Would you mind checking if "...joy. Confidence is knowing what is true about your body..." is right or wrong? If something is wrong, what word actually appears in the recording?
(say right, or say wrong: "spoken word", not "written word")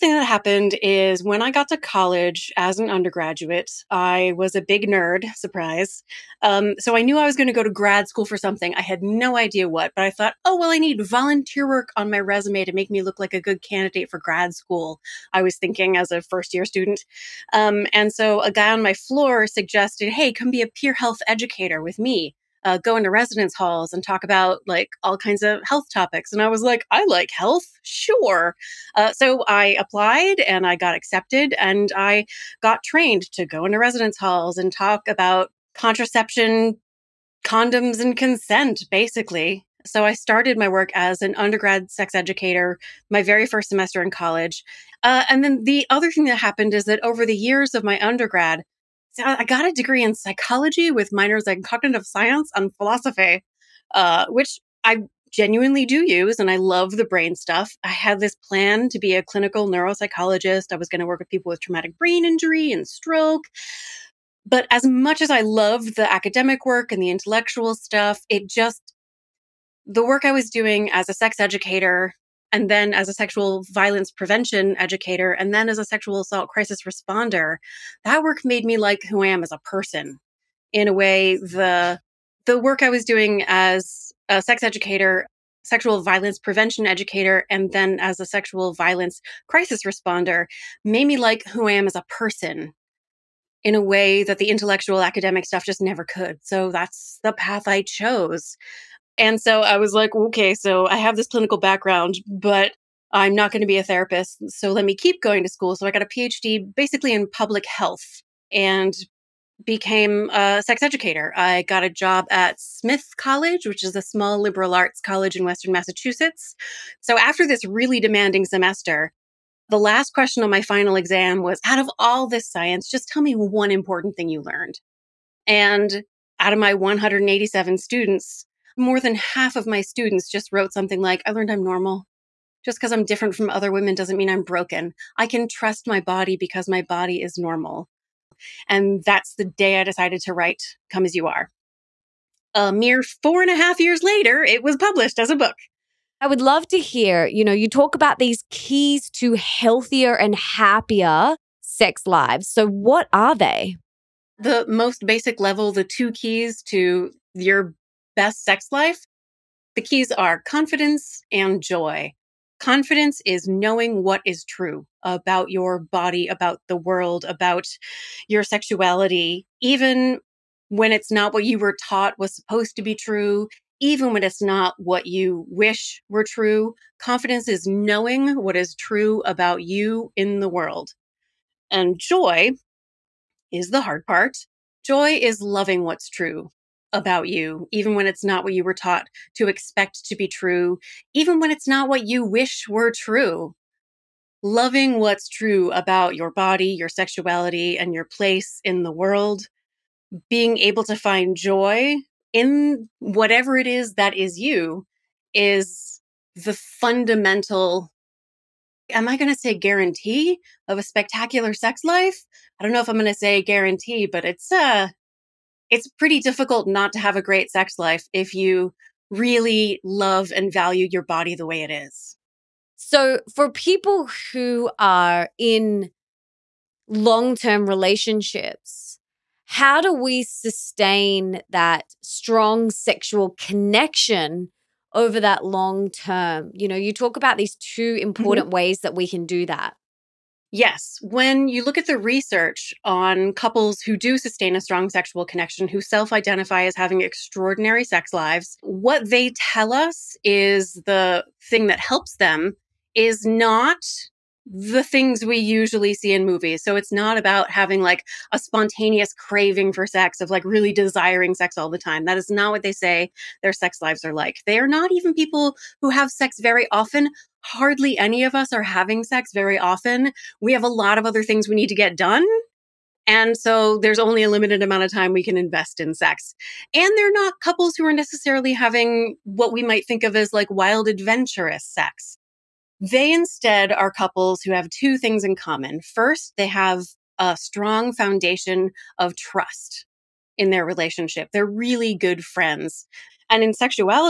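right.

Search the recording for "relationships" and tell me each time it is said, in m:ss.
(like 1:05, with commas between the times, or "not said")
3:47, 4:50.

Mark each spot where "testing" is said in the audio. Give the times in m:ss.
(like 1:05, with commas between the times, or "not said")
not said.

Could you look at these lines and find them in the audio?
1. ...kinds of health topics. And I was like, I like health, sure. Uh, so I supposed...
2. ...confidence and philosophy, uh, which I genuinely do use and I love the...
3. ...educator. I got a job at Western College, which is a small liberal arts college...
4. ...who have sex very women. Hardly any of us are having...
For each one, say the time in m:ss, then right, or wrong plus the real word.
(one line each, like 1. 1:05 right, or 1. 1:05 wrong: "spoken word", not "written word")
1. 0:25 wrong: "applied", not "supposed"
2. 0:52 wrong: "science", not "confidence"
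3. 1:50 wrong: "Smith", not "Western"
4. 4:25 wrong: "often", not "women".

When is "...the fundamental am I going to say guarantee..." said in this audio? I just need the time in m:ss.
3:26.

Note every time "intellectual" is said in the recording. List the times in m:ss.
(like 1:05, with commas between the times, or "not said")
1:07, 1:34.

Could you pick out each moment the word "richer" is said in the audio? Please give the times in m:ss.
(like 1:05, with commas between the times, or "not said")
not said.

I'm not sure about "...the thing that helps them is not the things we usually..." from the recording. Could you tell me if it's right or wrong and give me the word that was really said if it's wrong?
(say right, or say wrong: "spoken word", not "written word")
right.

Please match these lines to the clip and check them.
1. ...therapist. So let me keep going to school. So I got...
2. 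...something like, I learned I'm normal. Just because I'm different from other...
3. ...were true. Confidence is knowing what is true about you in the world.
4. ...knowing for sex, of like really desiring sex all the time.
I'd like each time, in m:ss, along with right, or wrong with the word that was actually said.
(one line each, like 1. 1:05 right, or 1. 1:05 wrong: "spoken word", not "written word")
1. 1:43 right
2. 2:10 right
3. 2:56 right
4. 4:19 wrong: "craving", not "knowing".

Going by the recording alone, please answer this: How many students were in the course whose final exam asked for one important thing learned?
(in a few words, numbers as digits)
187.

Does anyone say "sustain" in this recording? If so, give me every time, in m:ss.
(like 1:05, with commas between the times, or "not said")
3:50, 4:04.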